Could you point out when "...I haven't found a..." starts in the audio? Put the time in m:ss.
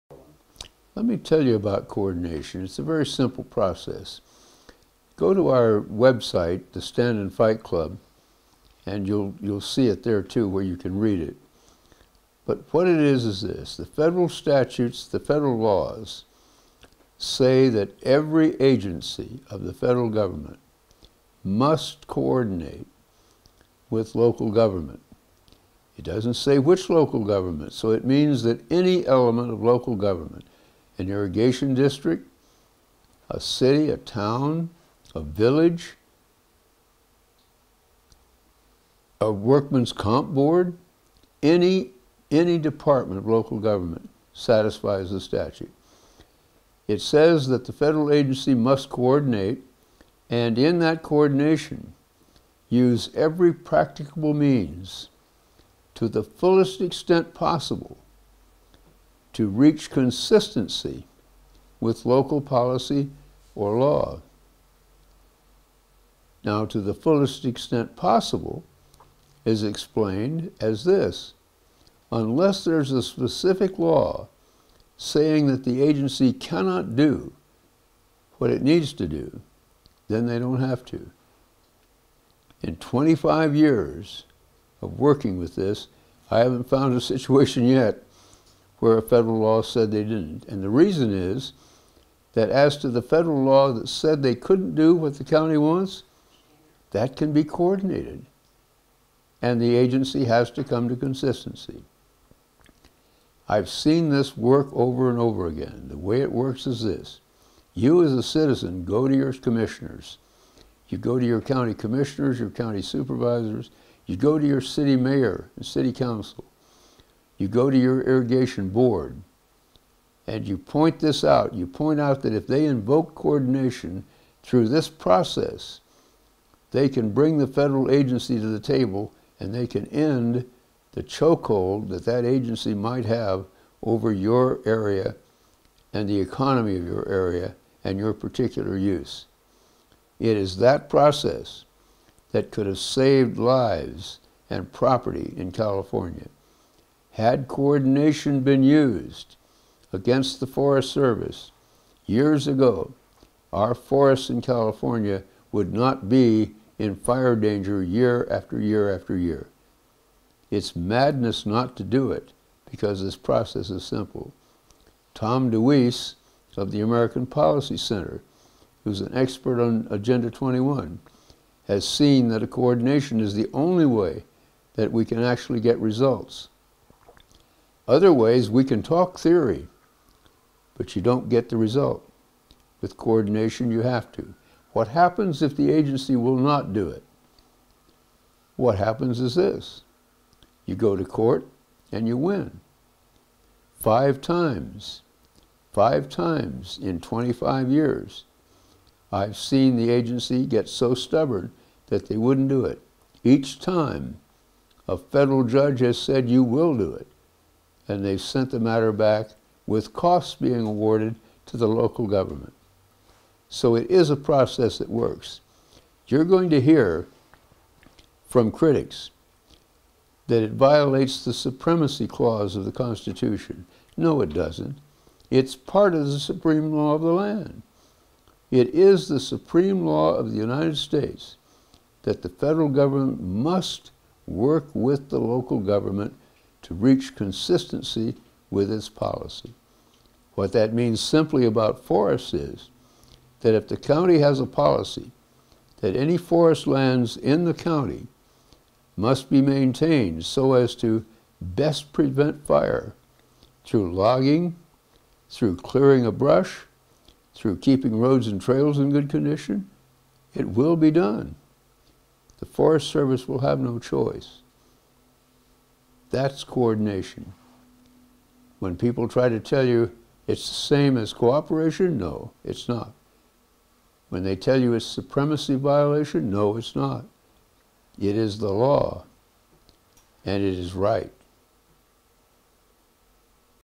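1:26.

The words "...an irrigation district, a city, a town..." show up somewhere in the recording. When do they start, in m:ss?
0:31.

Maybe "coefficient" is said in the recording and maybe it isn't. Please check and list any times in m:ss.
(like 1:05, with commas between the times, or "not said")
not said.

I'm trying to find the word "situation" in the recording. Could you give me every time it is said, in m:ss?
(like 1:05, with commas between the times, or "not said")
1:27.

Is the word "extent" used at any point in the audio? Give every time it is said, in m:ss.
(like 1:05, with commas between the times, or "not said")
0:56, 1:07.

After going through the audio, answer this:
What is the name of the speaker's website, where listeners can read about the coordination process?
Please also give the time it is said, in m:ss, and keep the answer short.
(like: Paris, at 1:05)
Stand and Fight Club, at 0:06.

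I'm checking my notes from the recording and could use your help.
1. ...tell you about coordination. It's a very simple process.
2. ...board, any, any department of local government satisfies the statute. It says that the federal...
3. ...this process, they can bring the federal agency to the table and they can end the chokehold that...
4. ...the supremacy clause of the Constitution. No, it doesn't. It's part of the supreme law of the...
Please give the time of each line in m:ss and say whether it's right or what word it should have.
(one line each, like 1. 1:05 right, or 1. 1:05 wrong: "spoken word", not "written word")
1. 0:01 right
2. 0:40 right
3. 2:04 right
4. 3:41 right.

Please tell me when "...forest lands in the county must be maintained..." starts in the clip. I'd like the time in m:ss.
4:06.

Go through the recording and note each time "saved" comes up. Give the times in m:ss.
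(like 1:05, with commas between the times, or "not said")
2:22.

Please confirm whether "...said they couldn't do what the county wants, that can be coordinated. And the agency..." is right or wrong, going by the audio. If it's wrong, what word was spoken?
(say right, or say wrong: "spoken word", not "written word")
right.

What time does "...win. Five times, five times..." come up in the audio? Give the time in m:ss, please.
3:12.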